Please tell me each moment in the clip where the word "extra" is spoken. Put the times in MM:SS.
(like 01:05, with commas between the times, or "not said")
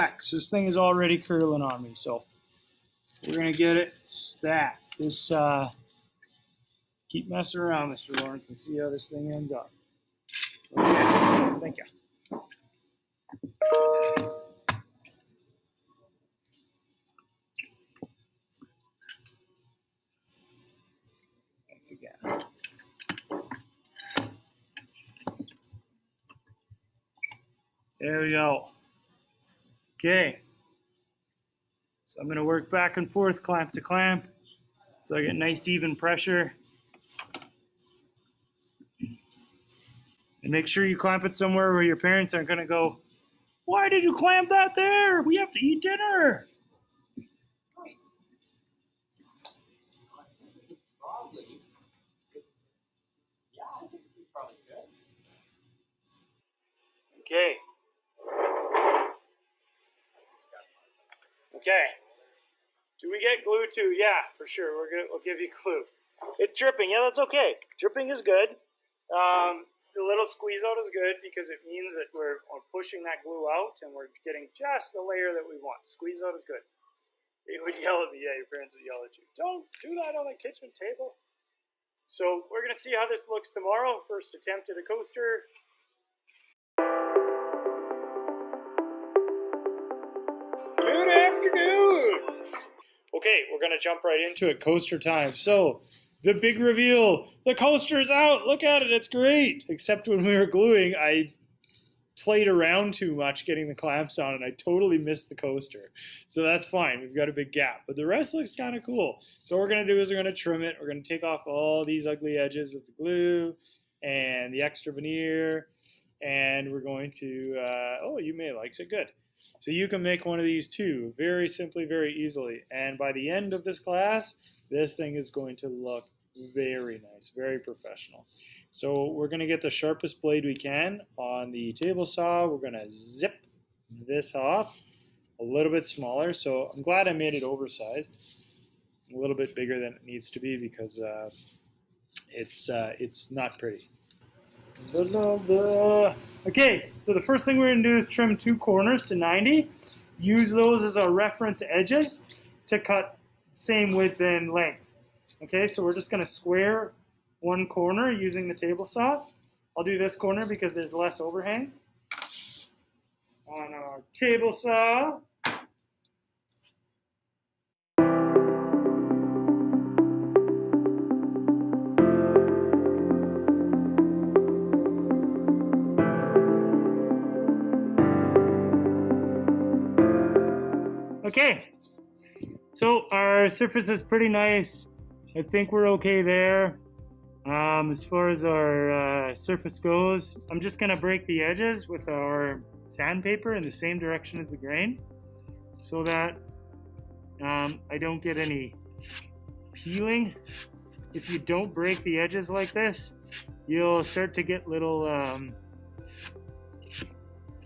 01:54.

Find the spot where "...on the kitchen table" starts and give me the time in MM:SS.
01:20.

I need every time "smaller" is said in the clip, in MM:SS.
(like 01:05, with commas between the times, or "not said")
02:15.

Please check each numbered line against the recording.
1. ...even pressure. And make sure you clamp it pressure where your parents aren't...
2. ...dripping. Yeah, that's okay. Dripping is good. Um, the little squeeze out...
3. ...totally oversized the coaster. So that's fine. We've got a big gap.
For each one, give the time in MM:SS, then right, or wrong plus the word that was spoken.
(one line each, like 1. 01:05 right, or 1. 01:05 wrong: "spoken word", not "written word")
1. 00:35 wrong: "somewhere", not "pressure"
2. 01:06 right
3. 01:44 wrong: "missed", not "oversized".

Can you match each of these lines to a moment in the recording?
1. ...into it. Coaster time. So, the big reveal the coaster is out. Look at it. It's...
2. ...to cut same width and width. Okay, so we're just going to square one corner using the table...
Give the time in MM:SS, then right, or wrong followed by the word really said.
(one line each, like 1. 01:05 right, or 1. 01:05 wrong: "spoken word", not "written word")
1. 01:34 right
2. 02:32 wrong: "length", not "width".